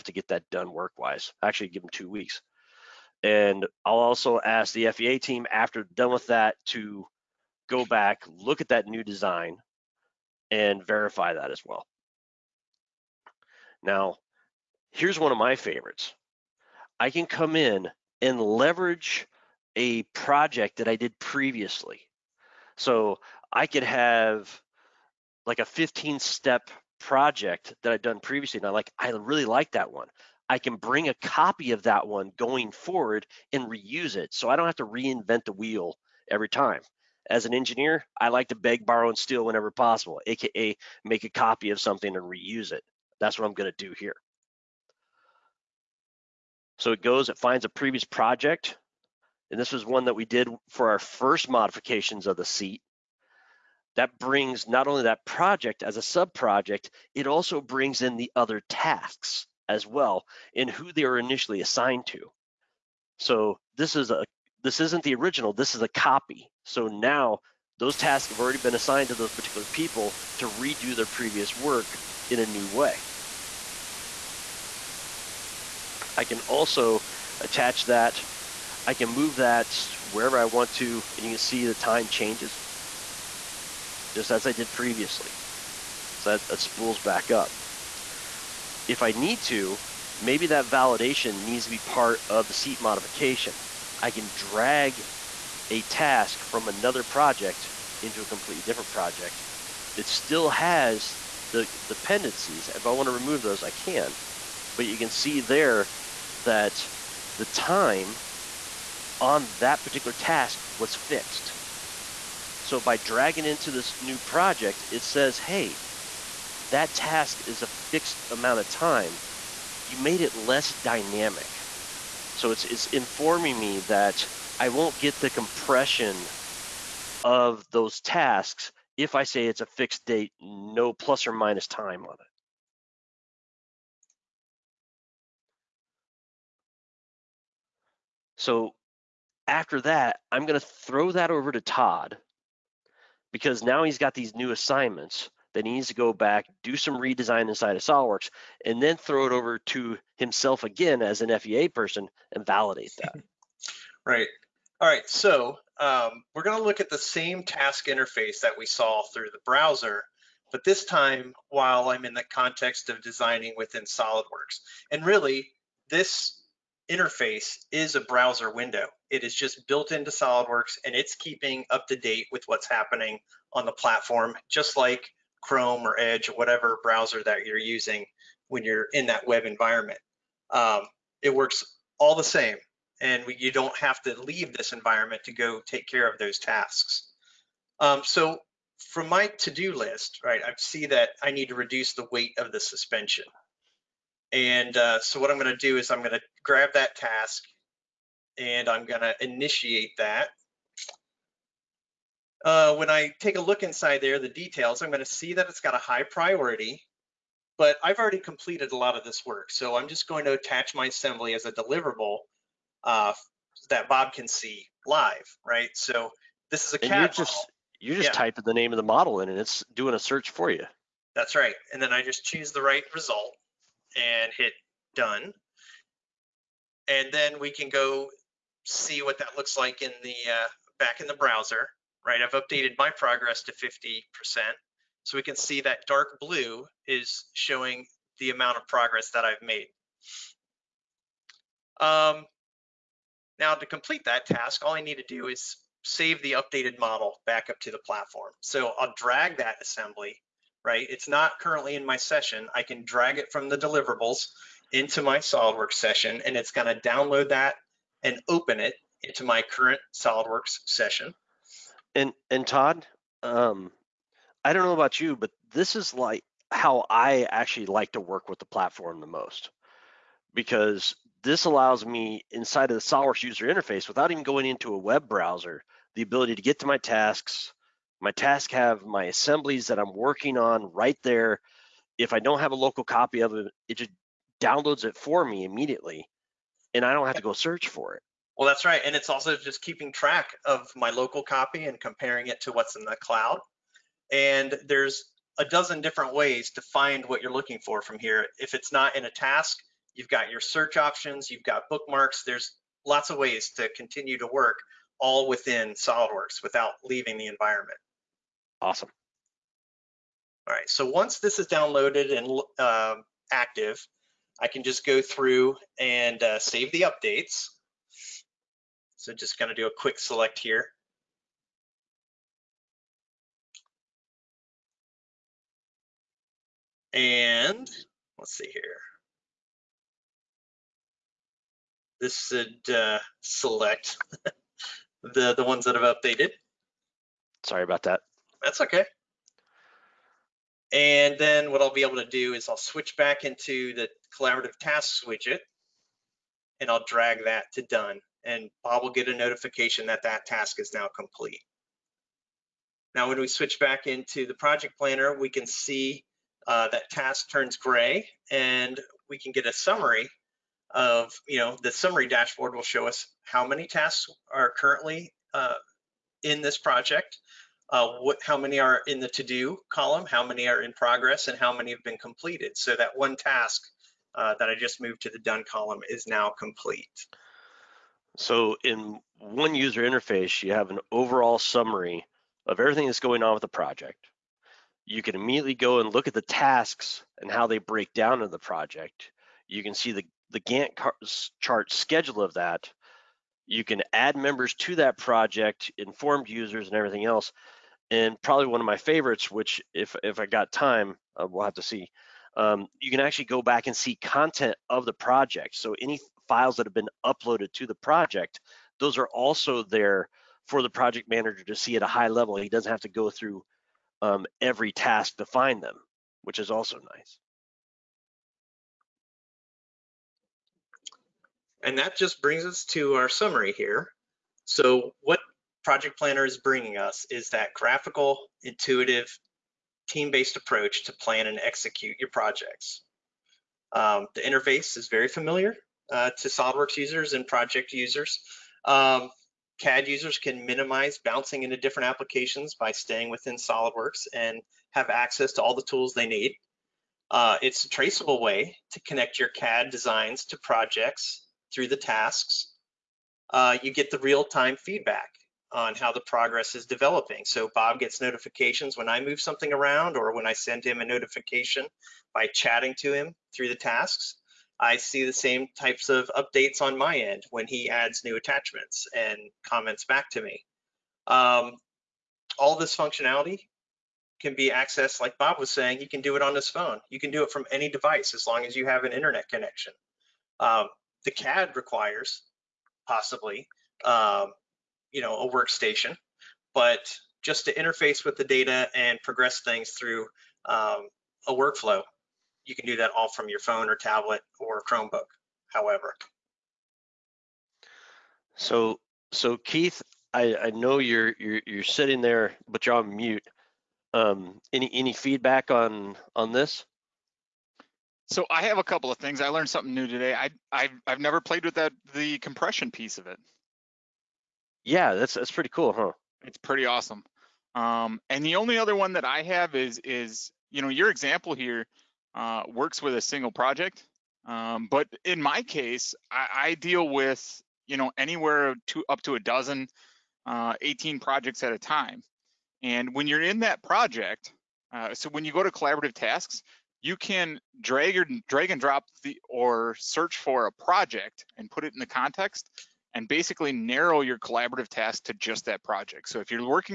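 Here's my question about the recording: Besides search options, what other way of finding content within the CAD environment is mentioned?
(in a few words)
Bookmarks.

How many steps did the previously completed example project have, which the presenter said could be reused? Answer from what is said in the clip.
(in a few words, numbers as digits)
15.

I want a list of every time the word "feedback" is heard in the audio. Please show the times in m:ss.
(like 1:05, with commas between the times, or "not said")
7:34, 8:24.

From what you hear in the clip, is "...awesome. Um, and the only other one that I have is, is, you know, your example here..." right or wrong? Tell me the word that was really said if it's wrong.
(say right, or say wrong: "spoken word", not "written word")
right.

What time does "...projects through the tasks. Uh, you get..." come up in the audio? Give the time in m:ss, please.
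7:30.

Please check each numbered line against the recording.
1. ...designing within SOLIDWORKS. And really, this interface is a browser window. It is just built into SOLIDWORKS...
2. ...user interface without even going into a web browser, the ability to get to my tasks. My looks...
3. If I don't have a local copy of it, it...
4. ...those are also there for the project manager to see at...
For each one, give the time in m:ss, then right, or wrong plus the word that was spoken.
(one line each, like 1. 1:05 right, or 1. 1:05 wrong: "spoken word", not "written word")
1. 2:43 right
2. 4:33 wrong: "tasks", not "looks"
3. 4:41 right
4. 6:48 right.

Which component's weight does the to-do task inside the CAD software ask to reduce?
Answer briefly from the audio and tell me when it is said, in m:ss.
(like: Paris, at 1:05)
The suspension, at 3:12.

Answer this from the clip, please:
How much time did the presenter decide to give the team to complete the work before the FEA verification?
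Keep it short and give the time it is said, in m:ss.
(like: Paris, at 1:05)
2 weeks, at 0:01.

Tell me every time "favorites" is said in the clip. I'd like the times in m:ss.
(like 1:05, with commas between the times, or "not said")
0:15, 6:38.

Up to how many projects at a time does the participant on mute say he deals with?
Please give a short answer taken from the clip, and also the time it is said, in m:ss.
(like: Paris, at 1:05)
18, at 8:50.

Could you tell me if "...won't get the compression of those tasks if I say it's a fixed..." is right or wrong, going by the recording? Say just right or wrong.
right.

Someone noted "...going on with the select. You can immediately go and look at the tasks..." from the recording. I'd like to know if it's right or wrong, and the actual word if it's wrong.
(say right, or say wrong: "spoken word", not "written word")
wrong: "project", not "select".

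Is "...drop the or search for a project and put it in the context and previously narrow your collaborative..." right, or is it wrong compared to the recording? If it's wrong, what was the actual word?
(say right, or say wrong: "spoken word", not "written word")
wrong: "basically", not "previously".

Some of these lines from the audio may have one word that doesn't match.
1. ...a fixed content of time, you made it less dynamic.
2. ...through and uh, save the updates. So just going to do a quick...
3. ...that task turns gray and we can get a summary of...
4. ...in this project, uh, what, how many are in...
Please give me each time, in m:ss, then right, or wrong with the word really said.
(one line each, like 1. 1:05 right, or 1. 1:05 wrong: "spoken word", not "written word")
1. 1:57 wrong: "amount", not "content"
2. 5:15 right
3. 5:56 right
4. 6:06 right.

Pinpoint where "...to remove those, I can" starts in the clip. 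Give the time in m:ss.
1:43.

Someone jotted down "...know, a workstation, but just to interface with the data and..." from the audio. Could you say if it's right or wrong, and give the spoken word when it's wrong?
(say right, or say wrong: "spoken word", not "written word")
right.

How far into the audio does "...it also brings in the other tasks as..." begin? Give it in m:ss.
0:57.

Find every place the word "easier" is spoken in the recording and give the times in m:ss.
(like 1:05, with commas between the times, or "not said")
not said.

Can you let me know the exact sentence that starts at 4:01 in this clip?
Um, now to complete that task, all I need to do is save the updated model back up to the platform.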